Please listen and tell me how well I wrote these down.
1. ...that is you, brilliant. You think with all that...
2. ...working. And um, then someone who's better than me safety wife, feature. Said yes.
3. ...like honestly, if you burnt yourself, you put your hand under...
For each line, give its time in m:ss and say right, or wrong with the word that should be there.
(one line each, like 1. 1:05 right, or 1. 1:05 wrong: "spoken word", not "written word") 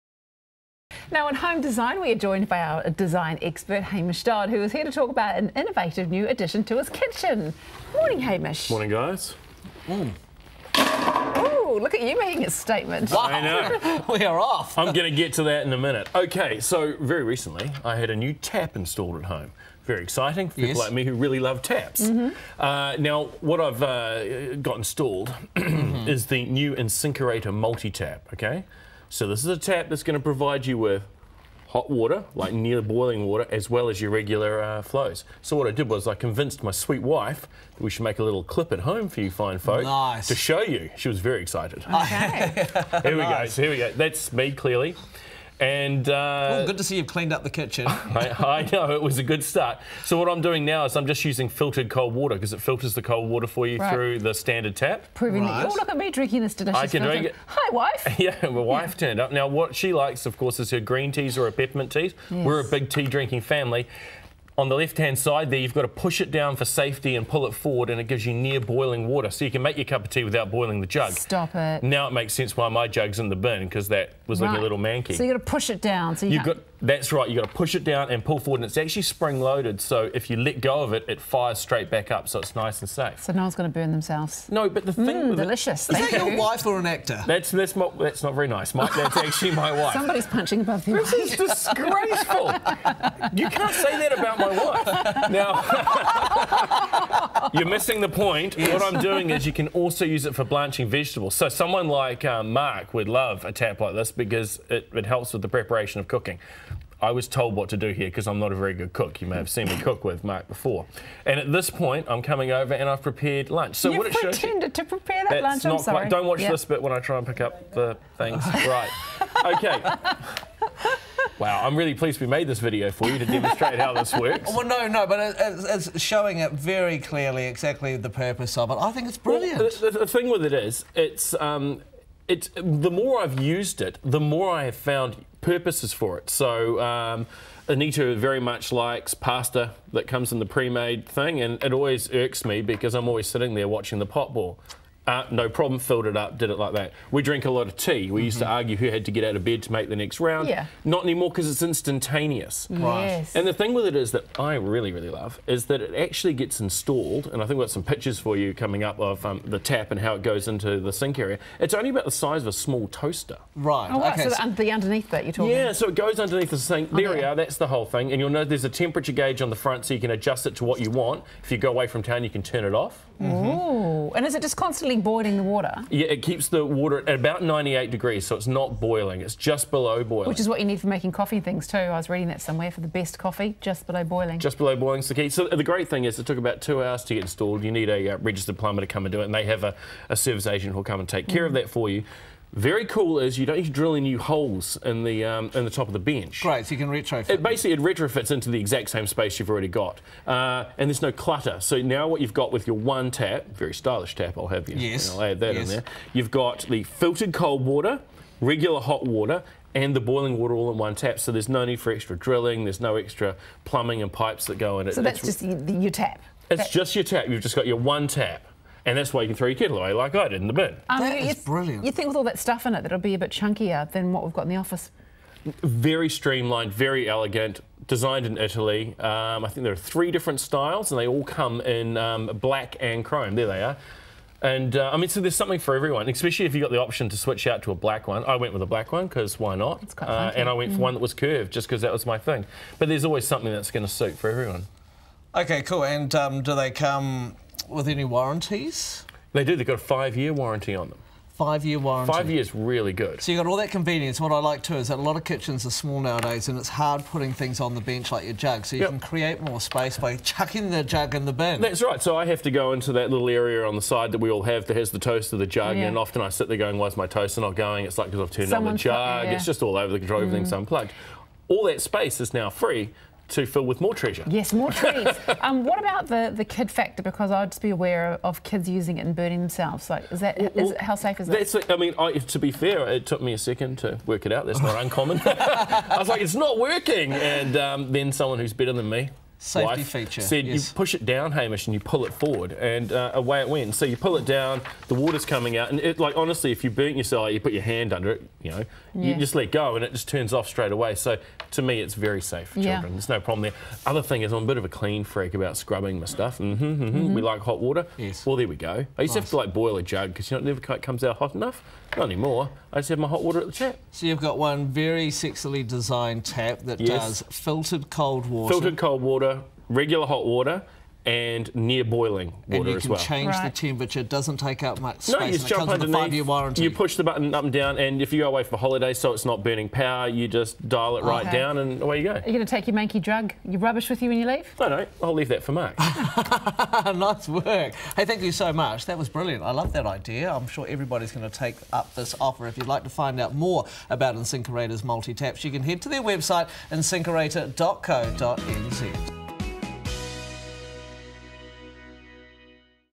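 1. 3:40 right
2. 4:46 right
3. 4:55 right.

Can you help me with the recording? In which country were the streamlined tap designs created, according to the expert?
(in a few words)
Italy.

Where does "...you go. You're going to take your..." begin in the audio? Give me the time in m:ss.
5:31.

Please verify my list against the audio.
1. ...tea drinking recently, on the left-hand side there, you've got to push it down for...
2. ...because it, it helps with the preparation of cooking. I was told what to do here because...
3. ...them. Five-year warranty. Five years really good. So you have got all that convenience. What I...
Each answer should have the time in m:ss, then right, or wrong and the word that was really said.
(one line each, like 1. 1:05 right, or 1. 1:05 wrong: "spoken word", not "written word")
1. 1:02 wrong: "family", not "recently"
2. 1:44 right
3. 4:10 right.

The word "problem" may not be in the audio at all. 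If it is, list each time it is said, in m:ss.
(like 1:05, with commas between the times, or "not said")
2:25, 5:03.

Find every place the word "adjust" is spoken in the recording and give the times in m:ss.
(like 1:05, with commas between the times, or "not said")
2:50.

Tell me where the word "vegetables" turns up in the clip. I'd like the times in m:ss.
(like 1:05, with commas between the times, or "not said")
1:40.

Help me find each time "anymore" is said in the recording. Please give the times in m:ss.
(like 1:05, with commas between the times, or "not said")
2:31, 5:12.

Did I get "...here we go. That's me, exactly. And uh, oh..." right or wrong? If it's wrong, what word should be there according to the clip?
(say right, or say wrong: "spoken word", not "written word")
wrong: "clearly", not "exactly".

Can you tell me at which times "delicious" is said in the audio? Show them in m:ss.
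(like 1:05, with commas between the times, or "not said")
0:56, 1:25.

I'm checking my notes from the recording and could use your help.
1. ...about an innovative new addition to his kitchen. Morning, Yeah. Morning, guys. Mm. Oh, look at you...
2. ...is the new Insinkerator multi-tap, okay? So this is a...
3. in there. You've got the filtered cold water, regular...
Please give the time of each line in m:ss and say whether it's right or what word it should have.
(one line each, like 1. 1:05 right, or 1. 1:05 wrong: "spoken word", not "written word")
1. 0:05 wrong: "Hamish", not "Yeah"
2. 0:26 right
3. 3:25 right.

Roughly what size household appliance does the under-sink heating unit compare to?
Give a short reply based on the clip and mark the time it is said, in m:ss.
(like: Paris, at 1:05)
A small toaster, at 2:42.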